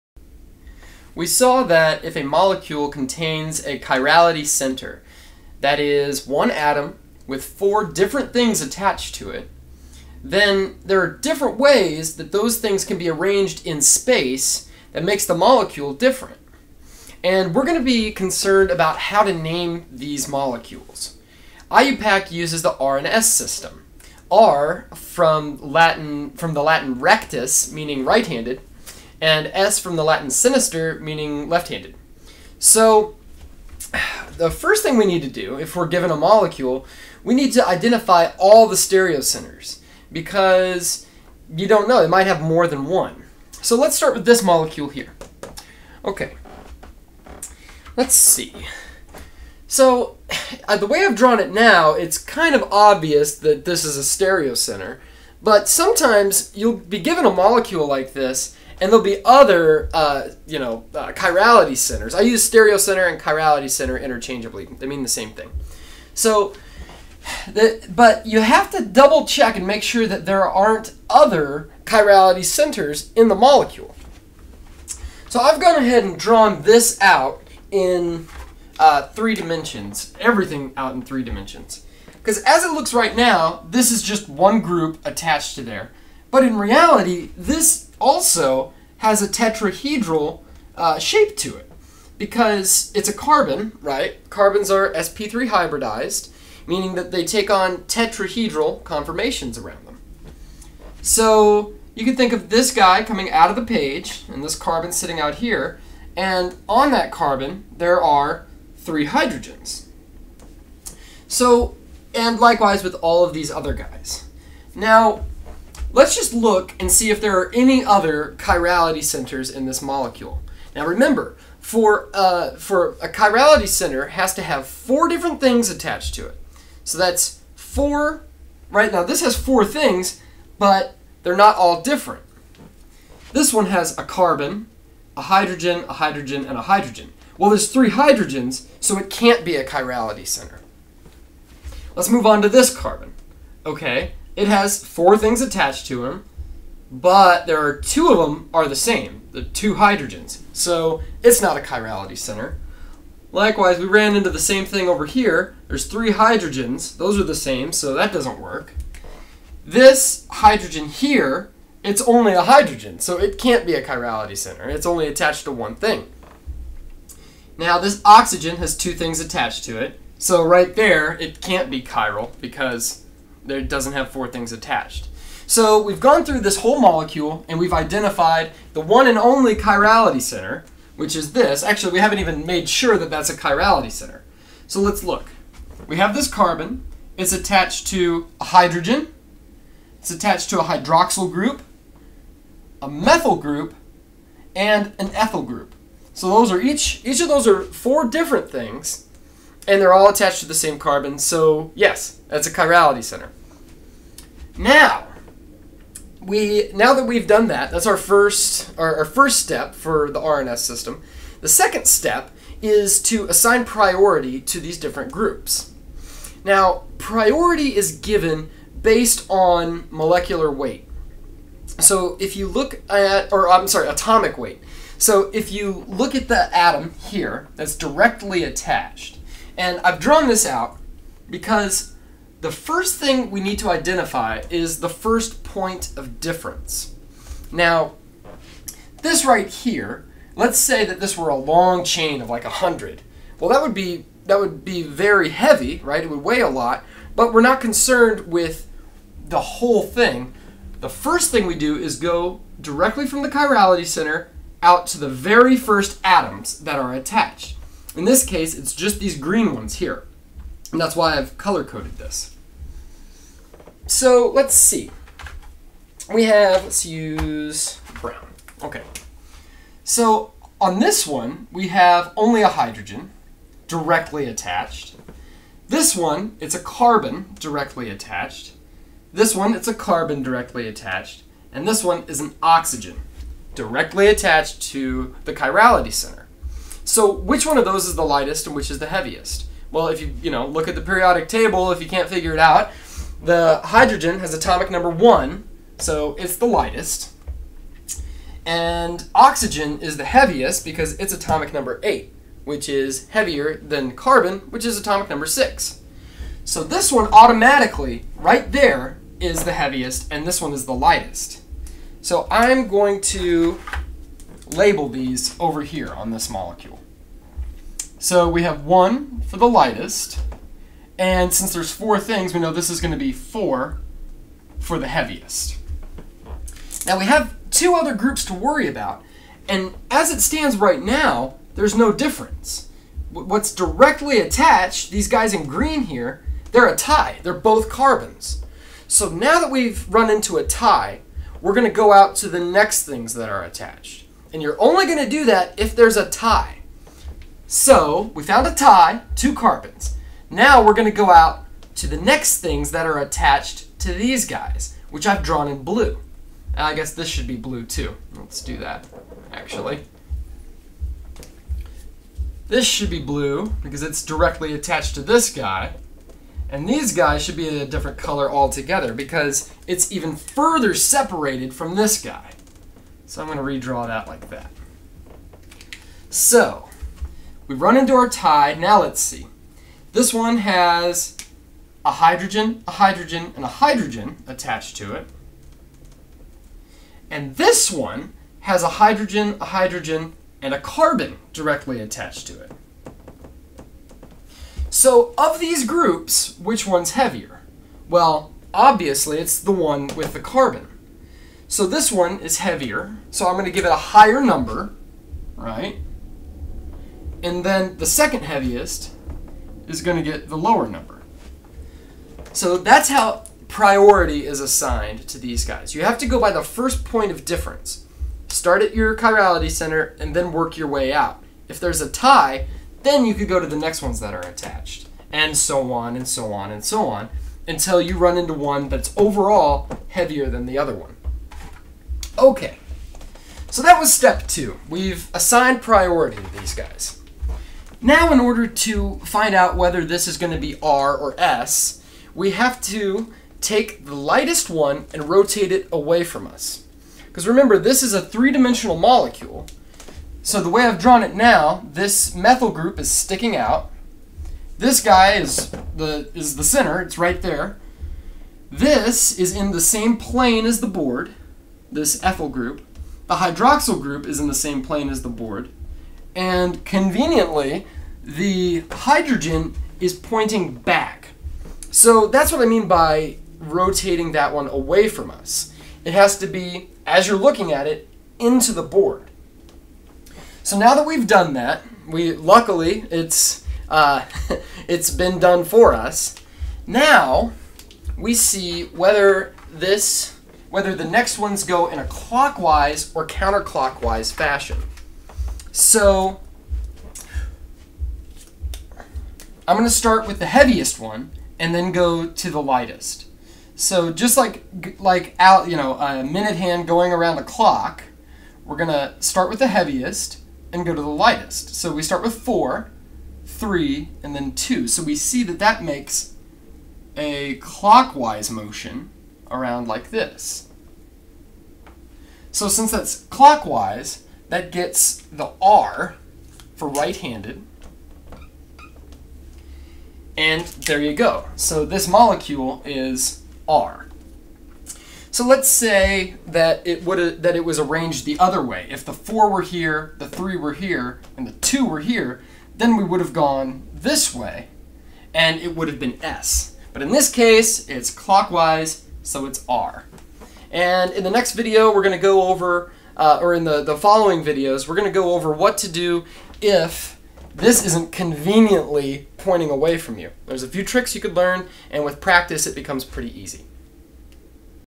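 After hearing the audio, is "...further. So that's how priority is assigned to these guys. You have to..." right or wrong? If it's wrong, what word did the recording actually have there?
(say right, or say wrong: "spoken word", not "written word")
wrong: "number", not "further".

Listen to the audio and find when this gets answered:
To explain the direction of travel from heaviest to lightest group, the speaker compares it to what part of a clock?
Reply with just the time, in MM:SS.
08:26.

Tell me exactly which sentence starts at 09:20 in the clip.
There's a few tricks you could learn, and with practice, it becomes pretty easy.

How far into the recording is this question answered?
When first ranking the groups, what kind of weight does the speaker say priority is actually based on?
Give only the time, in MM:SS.
03:43.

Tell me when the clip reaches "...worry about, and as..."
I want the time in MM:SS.
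05:28.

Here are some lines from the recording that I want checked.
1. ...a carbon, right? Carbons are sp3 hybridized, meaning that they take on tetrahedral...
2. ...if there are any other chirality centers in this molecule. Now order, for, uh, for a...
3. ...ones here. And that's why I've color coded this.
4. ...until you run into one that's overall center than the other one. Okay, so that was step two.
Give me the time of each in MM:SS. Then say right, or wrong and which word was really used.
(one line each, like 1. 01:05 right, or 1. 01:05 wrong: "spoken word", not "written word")
1. 01:33 right
2. 01:57 wrong: "remember", not "order"
3. 04:19 right
4. 07:07 wrong: "heavier", not "center".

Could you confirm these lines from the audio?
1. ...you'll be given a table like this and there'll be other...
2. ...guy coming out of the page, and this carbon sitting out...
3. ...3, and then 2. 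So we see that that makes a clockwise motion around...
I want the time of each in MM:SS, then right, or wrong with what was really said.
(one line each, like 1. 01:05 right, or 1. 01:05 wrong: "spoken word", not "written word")
1. 00:56 wrong: "molecule", not "table"
2. 01:42 right
3. 08:33 right.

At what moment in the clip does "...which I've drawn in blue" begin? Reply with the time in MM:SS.
05:54.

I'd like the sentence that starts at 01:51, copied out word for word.
So, and likewise with all of these other guys.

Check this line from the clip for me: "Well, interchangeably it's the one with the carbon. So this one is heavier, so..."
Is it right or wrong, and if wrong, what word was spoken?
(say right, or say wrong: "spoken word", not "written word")
wrong: "obviously", not "interchangeably".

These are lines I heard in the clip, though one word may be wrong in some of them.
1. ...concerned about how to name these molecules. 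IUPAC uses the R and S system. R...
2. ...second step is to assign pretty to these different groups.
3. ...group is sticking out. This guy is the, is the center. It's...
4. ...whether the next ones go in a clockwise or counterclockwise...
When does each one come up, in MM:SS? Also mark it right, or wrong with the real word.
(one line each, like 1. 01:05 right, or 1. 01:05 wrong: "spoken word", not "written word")
1. 00:18 right
2. 03:31 wrong: "priority", not "pretty"
3. 07:32 right
4. 08:10 right.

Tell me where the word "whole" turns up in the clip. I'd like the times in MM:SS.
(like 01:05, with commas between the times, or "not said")
02:56, 04:09.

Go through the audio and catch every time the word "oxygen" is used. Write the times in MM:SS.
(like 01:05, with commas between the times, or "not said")
02:48, 04:42, 04:59.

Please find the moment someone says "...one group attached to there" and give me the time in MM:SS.
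01:24.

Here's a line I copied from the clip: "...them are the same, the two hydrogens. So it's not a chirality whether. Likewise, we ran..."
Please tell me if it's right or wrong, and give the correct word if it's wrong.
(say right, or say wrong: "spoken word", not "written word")
wrong: "center", not "whether".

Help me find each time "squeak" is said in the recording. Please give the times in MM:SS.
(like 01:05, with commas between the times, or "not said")
not said.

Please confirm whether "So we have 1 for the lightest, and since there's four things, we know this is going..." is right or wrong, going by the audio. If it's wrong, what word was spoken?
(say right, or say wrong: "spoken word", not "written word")
right.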